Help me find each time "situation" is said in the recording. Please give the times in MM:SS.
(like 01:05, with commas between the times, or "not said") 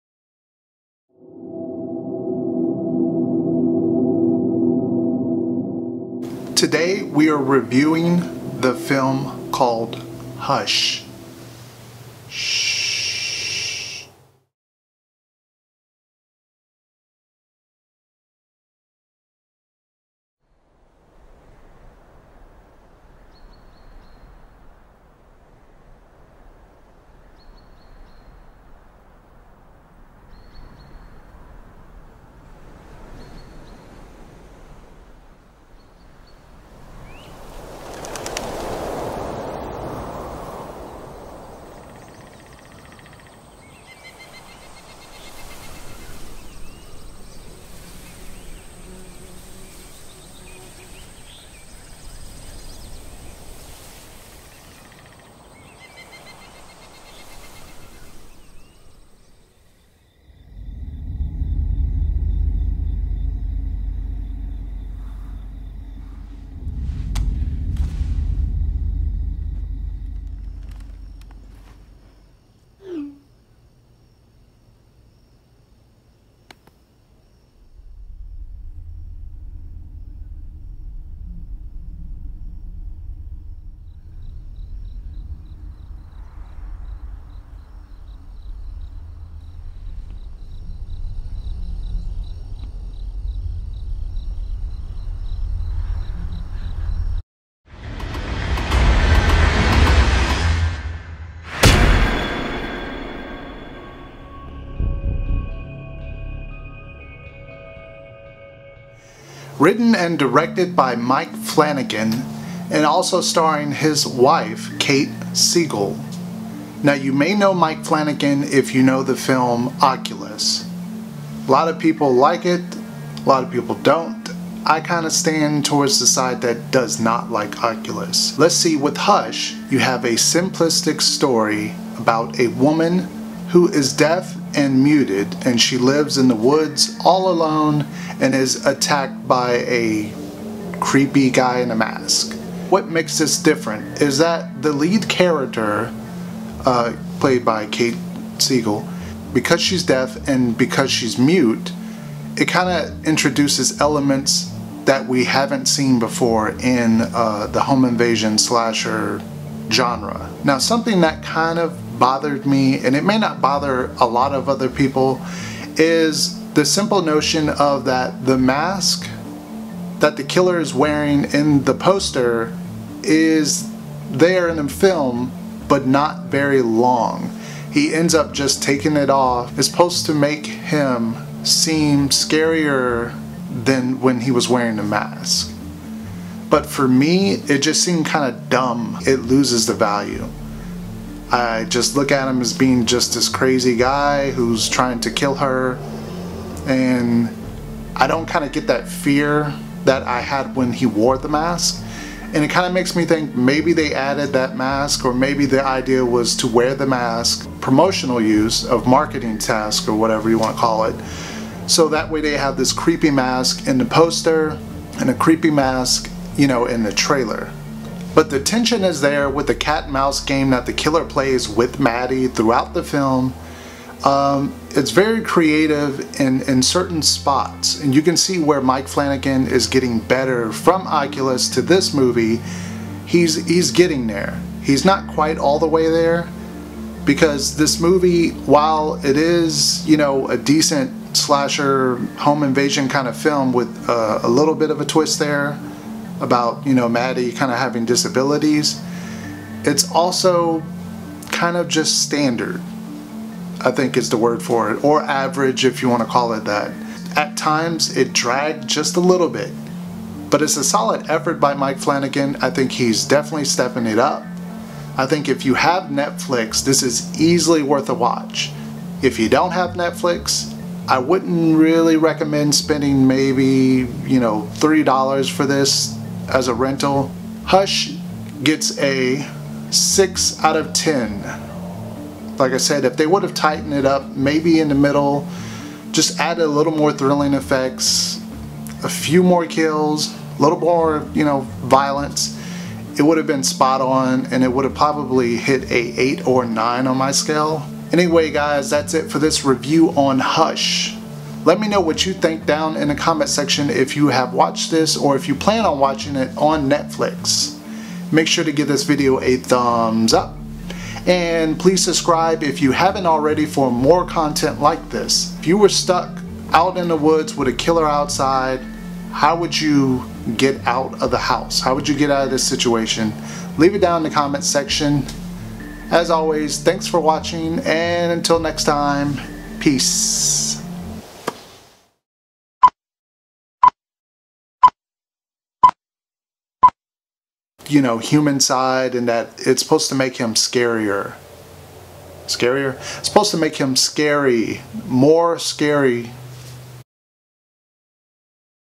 05:22.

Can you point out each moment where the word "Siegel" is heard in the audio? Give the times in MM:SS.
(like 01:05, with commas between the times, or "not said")
01:55, 02:28.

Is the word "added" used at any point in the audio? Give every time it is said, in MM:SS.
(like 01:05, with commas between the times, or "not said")
03:23, 04:46.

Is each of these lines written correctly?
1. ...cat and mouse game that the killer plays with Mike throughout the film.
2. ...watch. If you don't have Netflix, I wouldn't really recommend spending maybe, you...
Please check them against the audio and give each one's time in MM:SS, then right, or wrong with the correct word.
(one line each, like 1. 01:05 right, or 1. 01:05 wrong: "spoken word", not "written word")
1. 03:39 wrong: "Maddie", not "Mike"
2. 04:27 right.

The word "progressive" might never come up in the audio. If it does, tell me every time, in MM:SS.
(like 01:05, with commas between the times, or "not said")
not said.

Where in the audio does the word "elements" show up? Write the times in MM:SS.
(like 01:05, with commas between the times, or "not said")
02:33.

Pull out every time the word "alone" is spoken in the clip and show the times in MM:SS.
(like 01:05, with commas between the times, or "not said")
02:17.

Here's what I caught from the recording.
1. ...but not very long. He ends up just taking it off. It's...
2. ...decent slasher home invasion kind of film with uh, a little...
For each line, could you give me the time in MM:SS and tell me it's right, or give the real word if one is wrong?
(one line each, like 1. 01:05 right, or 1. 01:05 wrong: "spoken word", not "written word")
1. 02:55 right
2. 04:00 right.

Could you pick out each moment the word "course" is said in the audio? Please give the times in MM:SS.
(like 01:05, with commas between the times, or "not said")
not said.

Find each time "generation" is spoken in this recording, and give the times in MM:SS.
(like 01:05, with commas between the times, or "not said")
not said.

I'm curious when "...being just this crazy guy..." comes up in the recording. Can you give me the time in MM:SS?
03:12.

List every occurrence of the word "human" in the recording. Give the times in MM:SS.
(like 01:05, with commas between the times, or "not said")
05:37.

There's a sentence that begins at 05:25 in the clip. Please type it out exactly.
As always, thanks for watching and until next time, peace.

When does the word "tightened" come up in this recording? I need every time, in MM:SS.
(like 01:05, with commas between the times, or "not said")
04:43.